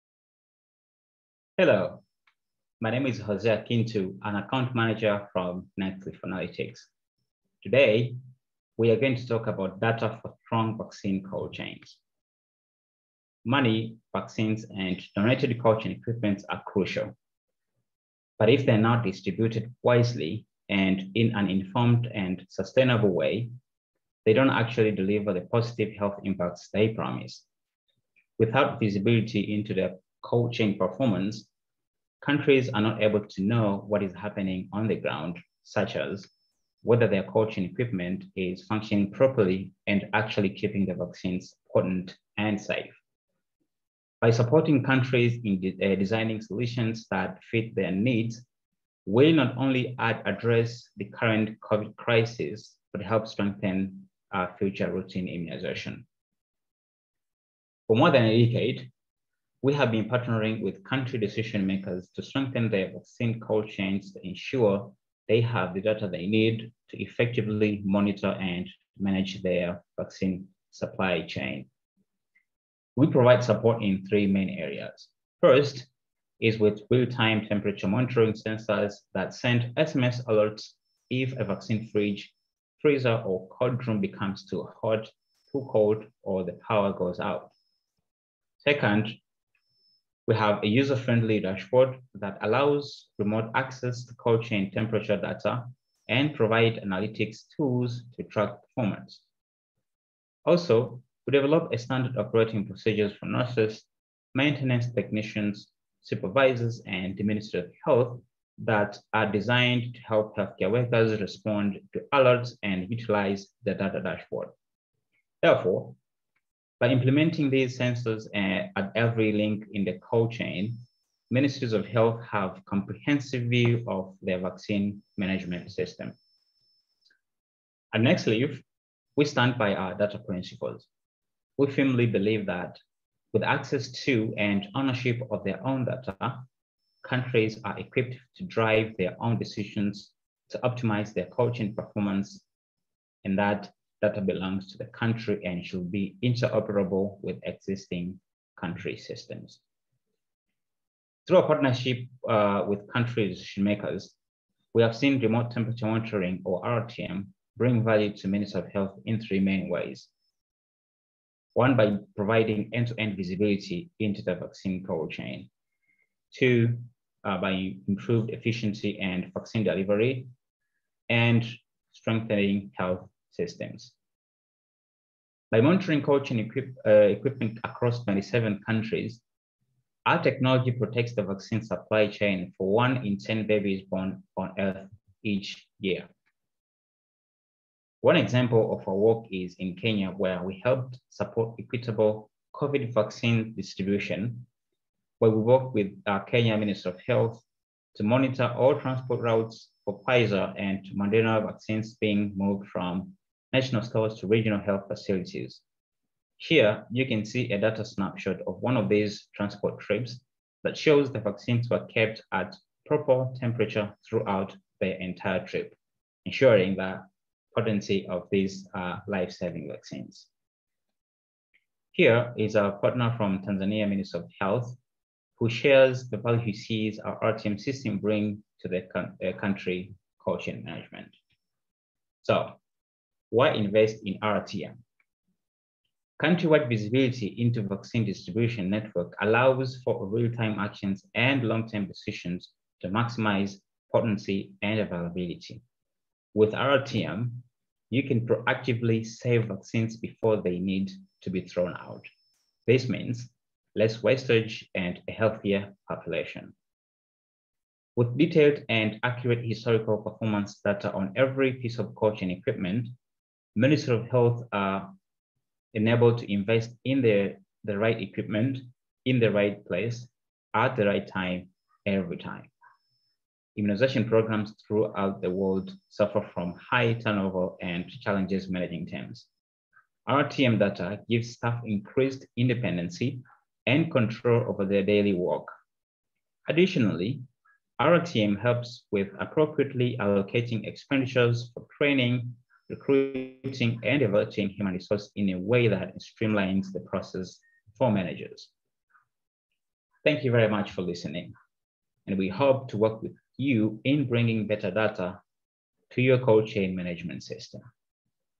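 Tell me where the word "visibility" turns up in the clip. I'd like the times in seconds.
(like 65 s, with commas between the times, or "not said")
28 s, 163 s, 236 s.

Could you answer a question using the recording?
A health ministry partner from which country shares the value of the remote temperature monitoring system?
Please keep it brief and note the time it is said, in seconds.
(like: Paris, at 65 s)
Tanzania, at 223 s.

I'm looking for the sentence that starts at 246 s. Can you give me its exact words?
With RTM, you can proactively save vaccines before they need to be thrown out.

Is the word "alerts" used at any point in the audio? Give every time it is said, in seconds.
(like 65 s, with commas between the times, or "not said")
80 s, 112 s.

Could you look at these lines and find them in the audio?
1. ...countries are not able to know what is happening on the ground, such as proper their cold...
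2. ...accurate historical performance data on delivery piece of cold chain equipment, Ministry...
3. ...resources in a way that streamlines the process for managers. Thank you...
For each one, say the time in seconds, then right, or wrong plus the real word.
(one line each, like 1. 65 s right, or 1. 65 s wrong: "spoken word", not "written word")
1. 32 s wrong: "whether", not "proper"
2. 259 s wrong: "every", not "delivery"
3. 294 s right.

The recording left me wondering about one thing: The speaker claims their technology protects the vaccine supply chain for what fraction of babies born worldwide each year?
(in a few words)
1 in 10.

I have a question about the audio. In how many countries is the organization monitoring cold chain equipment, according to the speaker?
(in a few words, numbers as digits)
27.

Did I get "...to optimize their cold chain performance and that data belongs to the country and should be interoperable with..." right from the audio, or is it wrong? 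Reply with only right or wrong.
right.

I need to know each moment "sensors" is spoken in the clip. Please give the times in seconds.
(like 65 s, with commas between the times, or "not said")
78 s, 117 s.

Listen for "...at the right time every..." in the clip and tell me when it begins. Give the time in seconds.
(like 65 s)
270 s.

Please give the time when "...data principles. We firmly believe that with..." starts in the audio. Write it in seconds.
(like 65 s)
129 s.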